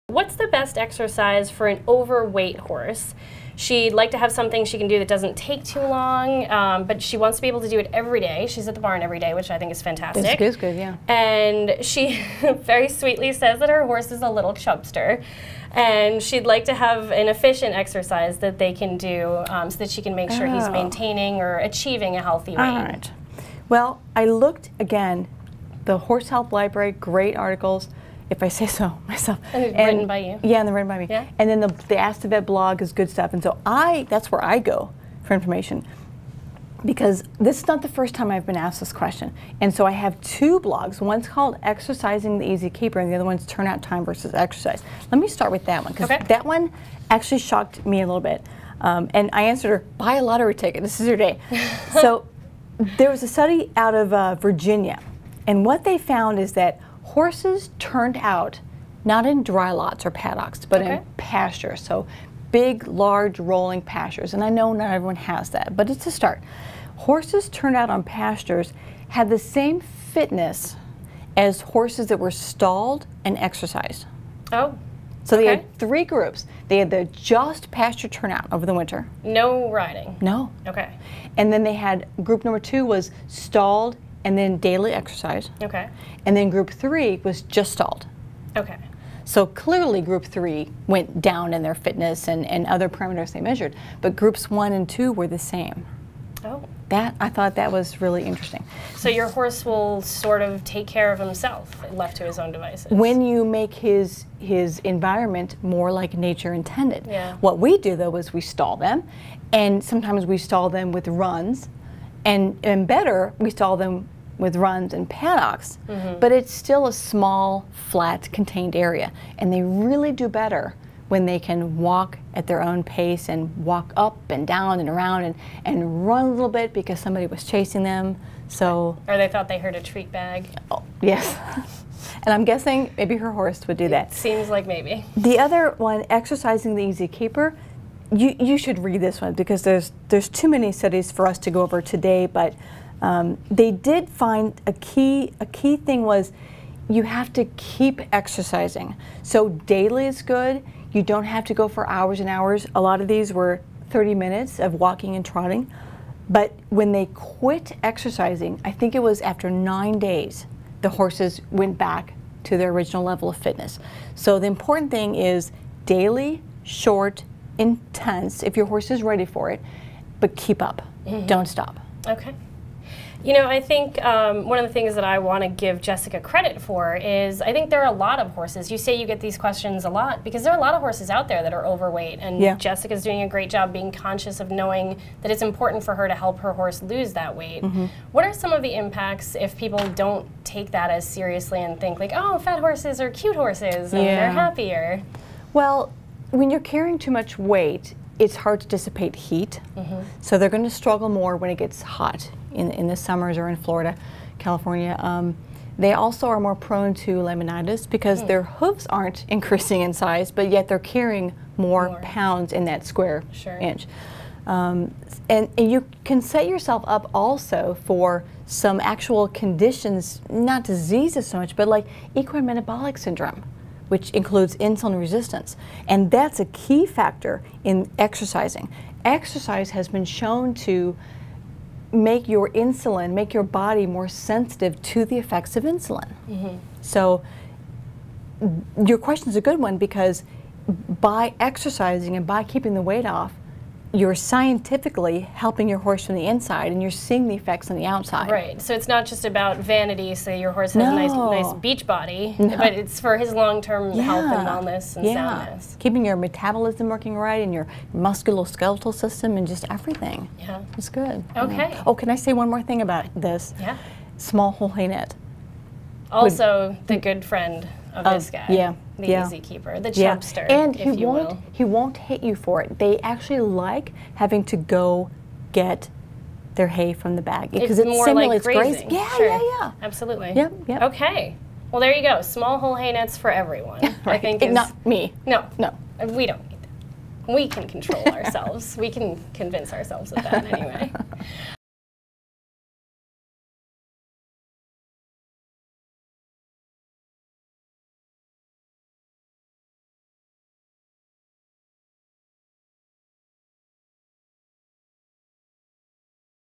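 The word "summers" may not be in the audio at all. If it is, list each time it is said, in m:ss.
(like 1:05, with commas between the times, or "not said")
3:22.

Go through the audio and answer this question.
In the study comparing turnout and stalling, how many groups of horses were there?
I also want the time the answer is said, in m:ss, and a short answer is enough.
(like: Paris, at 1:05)
3, at 1:15.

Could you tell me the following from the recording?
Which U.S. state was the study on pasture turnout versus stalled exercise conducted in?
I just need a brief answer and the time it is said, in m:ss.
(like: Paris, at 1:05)
Virginia, at 0:54.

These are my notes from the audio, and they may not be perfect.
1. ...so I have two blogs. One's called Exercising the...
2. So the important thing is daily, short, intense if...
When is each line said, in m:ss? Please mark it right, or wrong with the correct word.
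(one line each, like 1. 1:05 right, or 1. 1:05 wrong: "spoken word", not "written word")
1. 0:39 right
2. 2:44 right.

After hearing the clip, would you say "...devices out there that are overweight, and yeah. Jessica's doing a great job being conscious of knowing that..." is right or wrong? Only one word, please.
wrong.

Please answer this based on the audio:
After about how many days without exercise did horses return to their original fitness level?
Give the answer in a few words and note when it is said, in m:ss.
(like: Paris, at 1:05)
9 days, at 2:39.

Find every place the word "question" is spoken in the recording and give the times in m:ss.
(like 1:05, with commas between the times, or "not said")
0:38, 2:59, 3:59.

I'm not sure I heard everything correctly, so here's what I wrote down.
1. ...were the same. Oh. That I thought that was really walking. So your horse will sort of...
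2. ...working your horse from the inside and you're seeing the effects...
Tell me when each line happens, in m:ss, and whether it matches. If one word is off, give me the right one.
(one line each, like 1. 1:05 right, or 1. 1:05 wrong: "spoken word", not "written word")
1. 1:35 wrong: "interesting", not "walking"
2. 4:05 wrong: "helping", not "working".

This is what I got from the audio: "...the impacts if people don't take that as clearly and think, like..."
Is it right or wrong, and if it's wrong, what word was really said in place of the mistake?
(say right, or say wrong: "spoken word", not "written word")
wrong: "seriously", not "clearly".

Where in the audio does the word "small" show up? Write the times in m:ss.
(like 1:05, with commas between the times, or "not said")
1:56, 4:24, 4:42.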